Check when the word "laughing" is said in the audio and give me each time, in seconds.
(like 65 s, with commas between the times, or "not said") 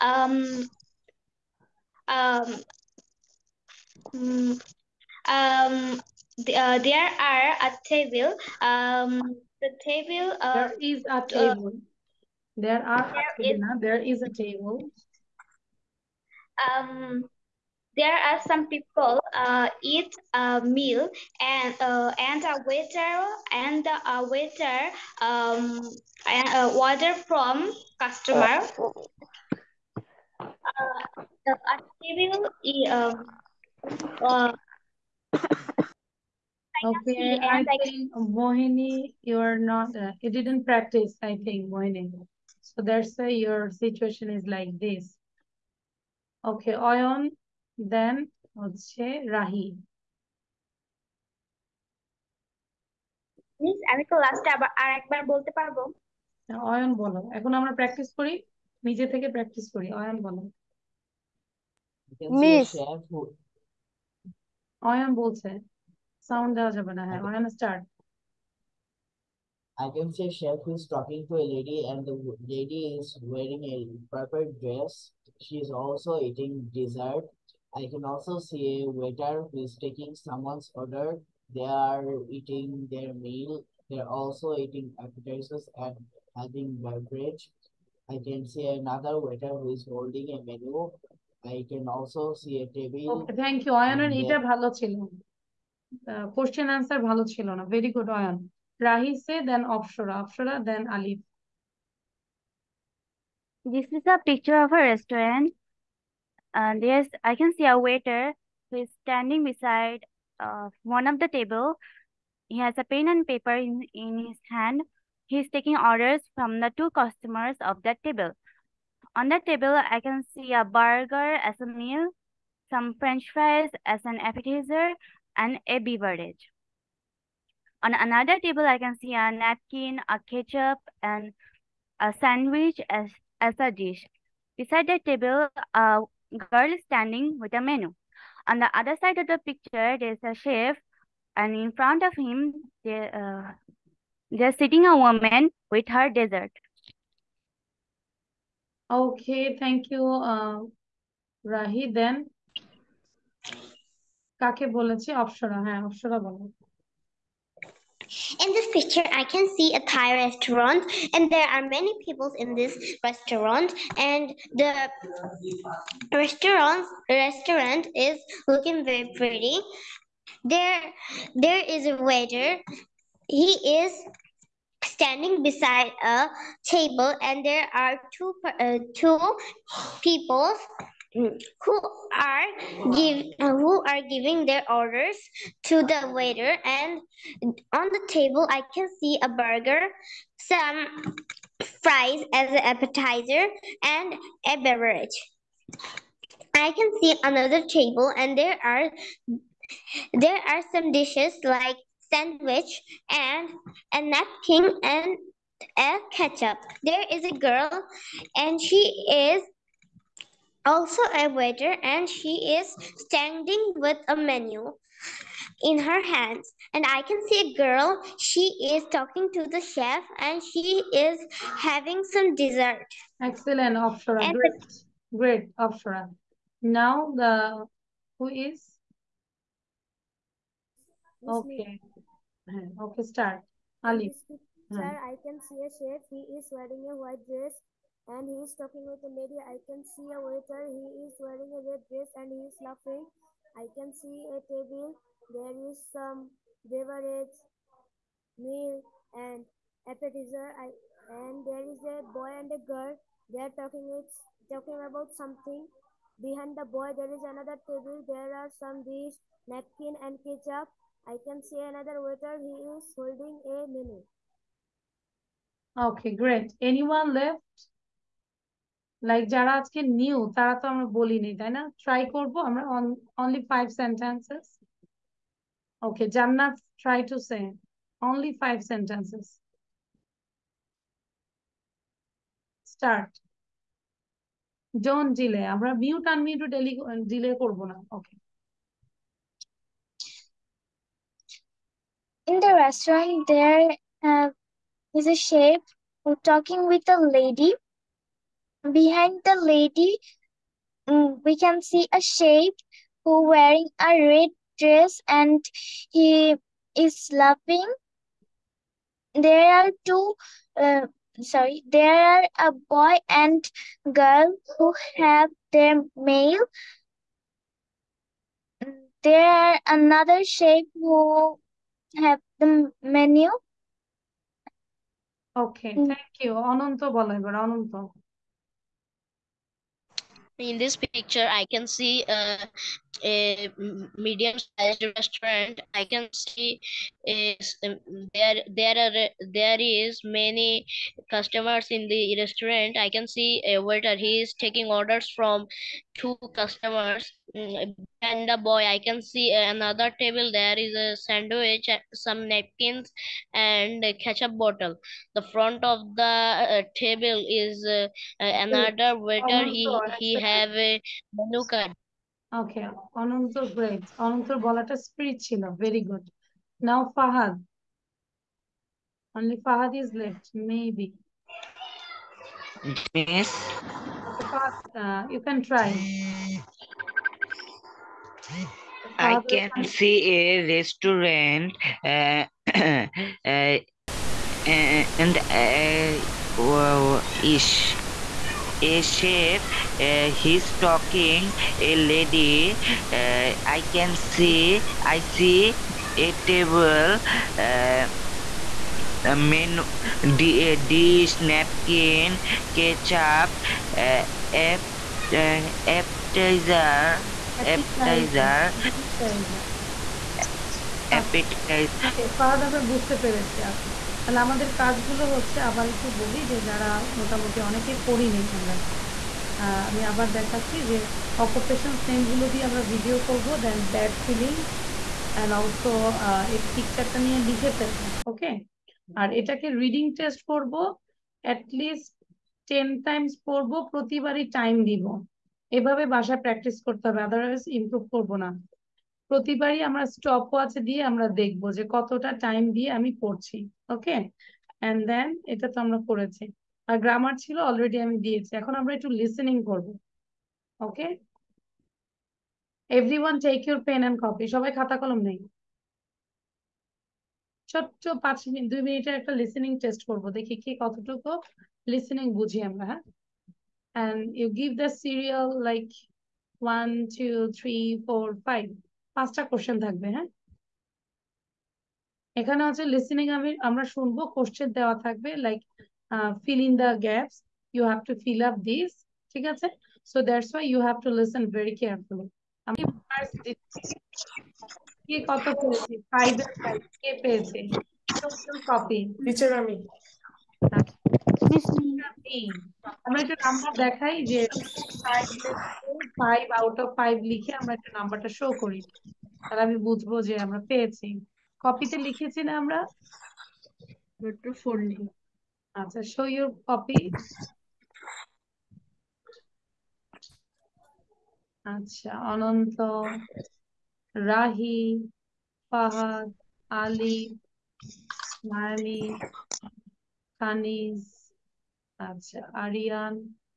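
242 s, 307 s.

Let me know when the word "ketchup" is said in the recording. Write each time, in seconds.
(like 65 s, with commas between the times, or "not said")
130 s, 206 s, 260 s, 354 s, 402 s.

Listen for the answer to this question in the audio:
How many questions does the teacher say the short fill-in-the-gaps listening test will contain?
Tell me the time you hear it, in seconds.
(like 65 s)
468 s.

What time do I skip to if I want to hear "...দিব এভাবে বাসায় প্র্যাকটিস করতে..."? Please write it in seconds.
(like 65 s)
434 s.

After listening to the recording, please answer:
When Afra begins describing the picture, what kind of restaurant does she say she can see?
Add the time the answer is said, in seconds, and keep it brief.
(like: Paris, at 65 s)
Thai restaurant, at 159 s.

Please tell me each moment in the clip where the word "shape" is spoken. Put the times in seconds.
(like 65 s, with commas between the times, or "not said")
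302 s, 320 s.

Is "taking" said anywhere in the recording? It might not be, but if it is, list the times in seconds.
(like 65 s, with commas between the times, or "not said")
79 s, 115 s, 344 s.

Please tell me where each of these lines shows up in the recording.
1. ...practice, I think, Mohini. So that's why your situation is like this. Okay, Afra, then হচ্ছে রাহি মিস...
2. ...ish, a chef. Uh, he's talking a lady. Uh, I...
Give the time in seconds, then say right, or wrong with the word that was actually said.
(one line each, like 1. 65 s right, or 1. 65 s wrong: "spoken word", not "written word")
1. 40 s wrong: "Oyon", not "Afra"
2. 387 s right.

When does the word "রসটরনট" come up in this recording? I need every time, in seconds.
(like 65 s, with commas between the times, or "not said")
292 s.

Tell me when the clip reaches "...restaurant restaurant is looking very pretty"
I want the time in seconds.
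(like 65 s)
166 s.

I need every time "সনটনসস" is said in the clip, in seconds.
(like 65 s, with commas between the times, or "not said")
273 s, 278 s.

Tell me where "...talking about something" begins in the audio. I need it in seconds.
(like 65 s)
254 s.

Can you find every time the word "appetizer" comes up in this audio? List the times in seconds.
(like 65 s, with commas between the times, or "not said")
85 s, 124 s, 192 s, 249 s, 405 s.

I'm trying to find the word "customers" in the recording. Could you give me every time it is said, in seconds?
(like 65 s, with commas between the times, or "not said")
27 s, 117 s, 341 s, 346 s.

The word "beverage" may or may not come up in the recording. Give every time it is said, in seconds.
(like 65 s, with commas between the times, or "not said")
86 s, 125 s, 194 s, 246 s.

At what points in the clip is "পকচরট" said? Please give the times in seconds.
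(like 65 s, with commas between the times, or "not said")
426 s.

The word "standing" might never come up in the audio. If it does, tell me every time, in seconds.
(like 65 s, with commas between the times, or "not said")
109 s, 136 s, 174 s, 212 s.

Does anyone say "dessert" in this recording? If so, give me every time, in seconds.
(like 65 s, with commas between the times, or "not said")
76 s, 146 s, 222 s.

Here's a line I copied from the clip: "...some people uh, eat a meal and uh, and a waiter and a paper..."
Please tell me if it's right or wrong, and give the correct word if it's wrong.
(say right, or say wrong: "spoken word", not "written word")
wrong: "waiter", not "paper".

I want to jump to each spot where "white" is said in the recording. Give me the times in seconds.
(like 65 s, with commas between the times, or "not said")
236 s.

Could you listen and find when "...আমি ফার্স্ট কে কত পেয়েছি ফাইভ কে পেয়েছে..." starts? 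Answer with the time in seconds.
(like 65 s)
482 s.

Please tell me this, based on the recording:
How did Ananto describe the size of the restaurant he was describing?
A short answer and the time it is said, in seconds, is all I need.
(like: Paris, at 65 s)
medium sized, at 333 s.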